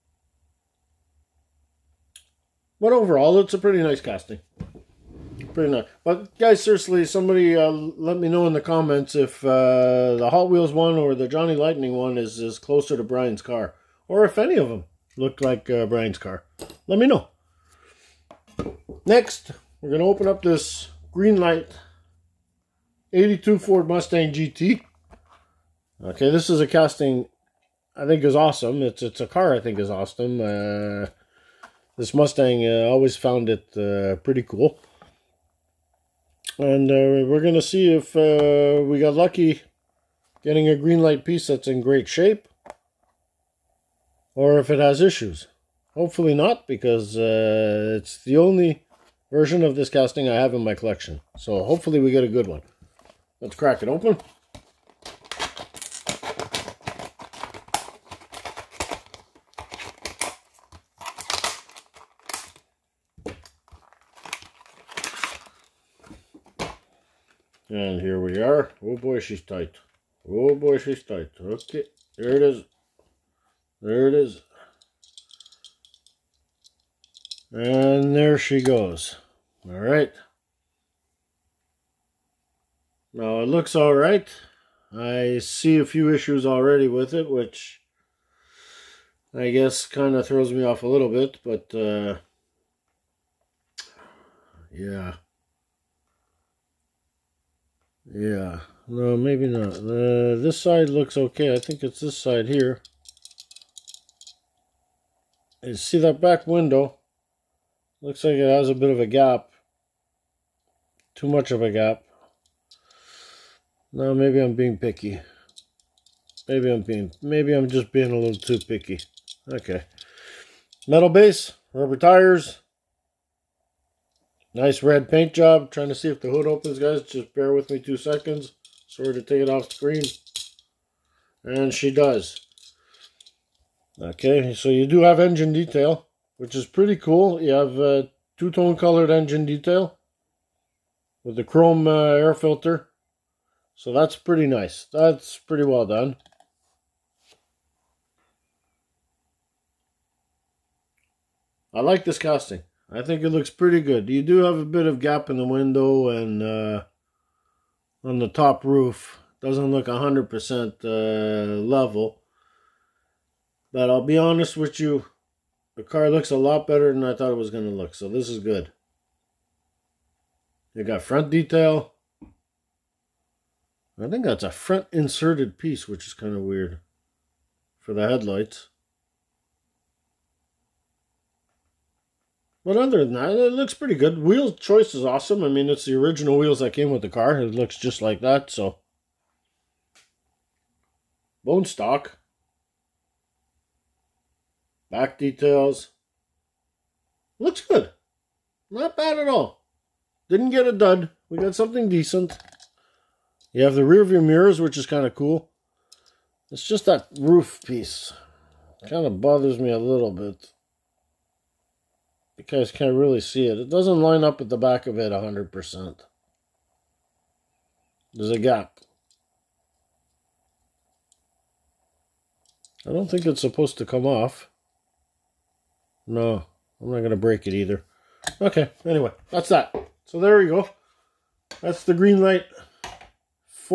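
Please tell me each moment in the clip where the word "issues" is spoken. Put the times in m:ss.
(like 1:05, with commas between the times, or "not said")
0:45, 1:26.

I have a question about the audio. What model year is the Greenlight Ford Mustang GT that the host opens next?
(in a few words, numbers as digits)
1982.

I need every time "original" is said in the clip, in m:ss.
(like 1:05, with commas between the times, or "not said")
3:05.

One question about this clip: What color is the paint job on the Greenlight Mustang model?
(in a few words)
Red.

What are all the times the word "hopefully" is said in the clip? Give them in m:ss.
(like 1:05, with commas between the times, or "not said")
0:45, 0:51.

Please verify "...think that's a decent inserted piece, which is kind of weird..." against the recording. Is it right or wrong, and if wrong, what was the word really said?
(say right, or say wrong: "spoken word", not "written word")
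wrong: "front", not "decent".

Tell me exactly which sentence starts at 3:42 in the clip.
I don't think it's supposed to come off.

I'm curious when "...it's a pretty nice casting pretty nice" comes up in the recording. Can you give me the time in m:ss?
0:03.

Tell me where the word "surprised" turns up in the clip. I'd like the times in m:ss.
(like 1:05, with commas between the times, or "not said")
not said.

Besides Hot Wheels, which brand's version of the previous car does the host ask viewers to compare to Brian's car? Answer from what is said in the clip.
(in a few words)
Johnny Lightning.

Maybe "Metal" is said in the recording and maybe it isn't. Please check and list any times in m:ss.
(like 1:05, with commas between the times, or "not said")
2:00.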